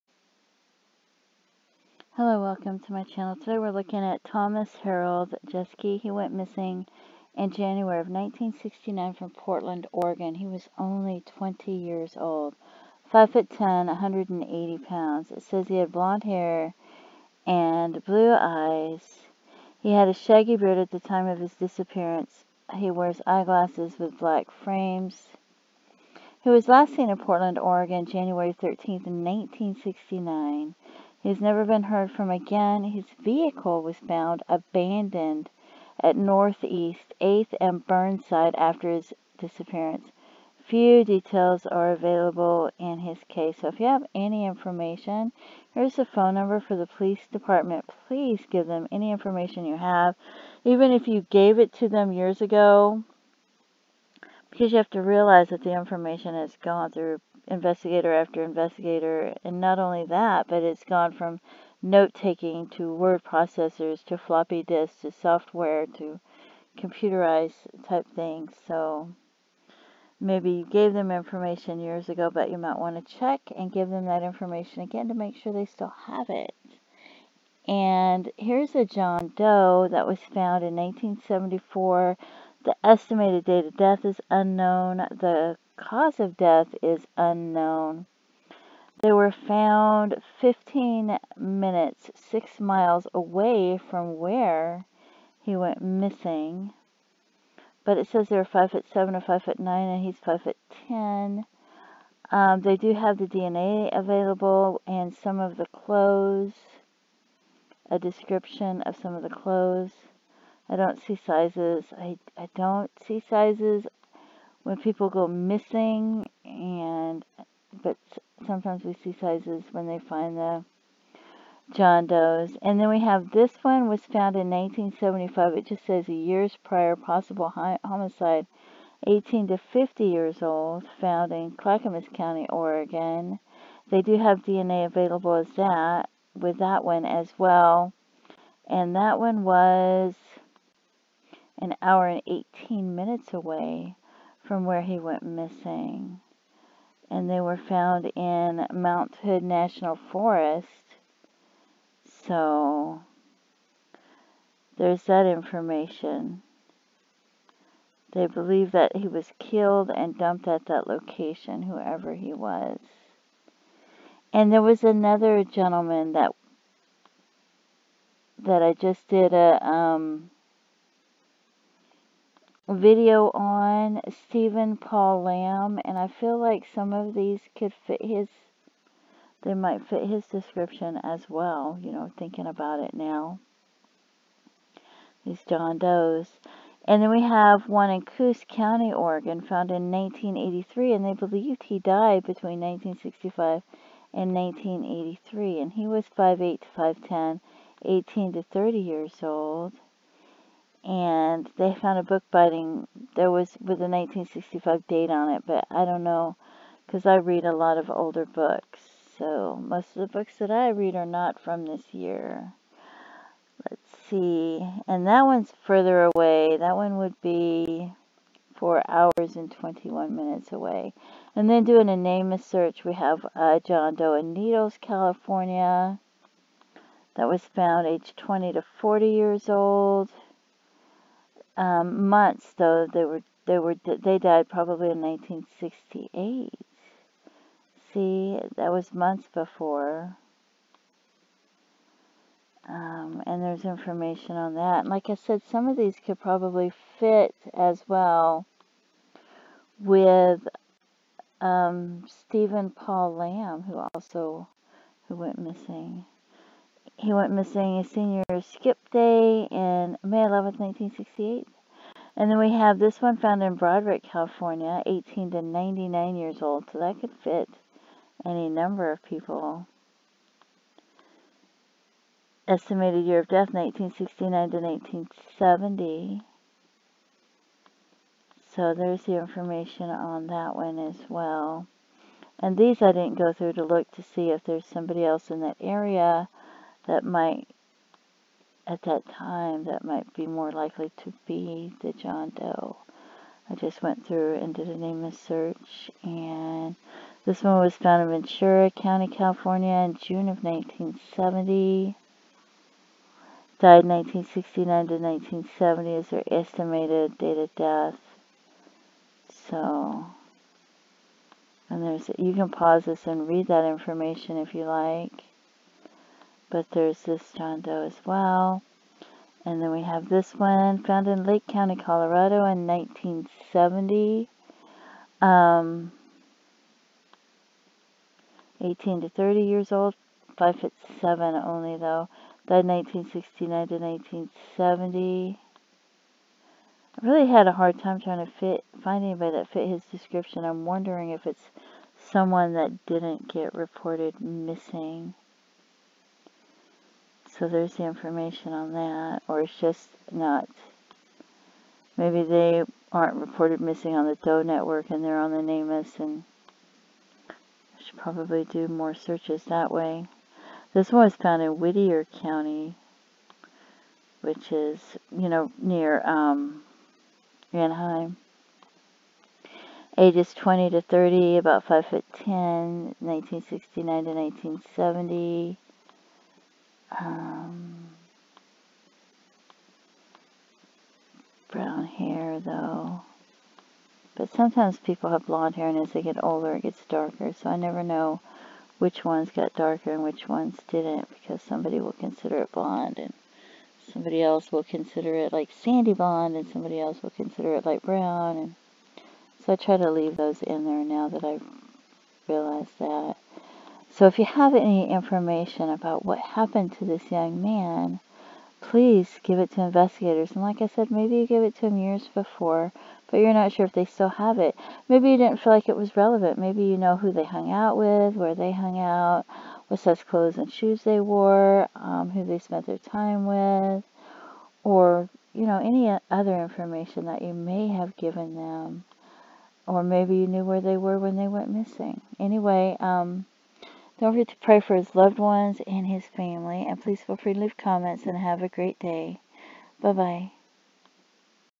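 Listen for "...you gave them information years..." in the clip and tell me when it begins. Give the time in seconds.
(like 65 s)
70 s.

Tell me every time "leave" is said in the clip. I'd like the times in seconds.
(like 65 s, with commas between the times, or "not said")
399 s, 437 s.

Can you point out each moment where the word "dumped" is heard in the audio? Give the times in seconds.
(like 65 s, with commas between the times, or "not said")
160 s.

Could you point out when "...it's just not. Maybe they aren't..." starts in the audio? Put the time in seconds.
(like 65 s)
349 s.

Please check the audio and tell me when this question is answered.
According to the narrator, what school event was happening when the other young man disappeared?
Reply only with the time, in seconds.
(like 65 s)
257 s.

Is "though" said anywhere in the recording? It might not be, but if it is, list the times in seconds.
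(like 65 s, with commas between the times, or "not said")
232 s, 331 s, 382 s.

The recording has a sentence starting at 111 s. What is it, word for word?
I, I don't see sizes when people go missing and but sometimes we see sizes when they find the John Doe's.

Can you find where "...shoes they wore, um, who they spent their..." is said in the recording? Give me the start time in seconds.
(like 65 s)
420 s.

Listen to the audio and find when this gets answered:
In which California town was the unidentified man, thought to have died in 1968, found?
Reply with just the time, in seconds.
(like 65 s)
224 s.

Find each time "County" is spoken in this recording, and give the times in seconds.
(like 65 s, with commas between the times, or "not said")
132 s, 188 s, 298 s, 321 s, 362 s.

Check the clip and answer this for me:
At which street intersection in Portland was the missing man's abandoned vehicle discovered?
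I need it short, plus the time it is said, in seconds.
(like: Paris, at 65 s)
Northeast 8th and Burnside, at 36 s.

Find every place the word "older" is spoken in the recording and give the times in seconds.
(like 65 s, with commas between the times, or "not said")
207 s, 386 s.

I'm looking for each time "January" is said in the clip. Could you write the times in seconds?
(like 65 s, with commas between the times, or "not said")
7 s, 28 s.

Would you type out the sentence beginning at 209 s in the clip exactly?
So most of the books that I read are not from this year.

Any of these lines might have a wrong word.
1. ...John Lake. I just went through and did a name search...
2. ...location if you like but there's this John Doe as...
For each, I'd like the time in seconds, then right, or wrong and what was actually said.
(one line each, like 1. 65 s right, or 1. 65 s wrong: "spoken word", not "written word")
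1. 291 s wrong: "Doe", not "Lake"
2. 313 s wrong: "information", not "location".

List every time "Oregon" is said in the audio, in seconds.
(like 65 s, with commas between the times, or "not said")
9 s, 27 s, 132 s, 188 s.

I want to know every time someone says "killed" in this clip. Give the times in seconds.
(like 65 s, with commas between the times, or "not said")
159 s.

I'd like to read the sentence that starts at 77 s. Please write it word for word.
And here's a John Doe that was found in 1974.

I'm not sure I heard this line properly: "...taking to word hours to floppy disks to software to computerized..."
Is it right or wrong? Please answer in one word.
wrong.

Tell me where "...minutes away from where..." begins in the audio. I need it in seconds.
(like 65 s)
142 s.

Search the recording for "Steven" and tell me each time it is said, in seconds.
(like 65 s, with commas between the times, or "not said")
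174 s, 252 s.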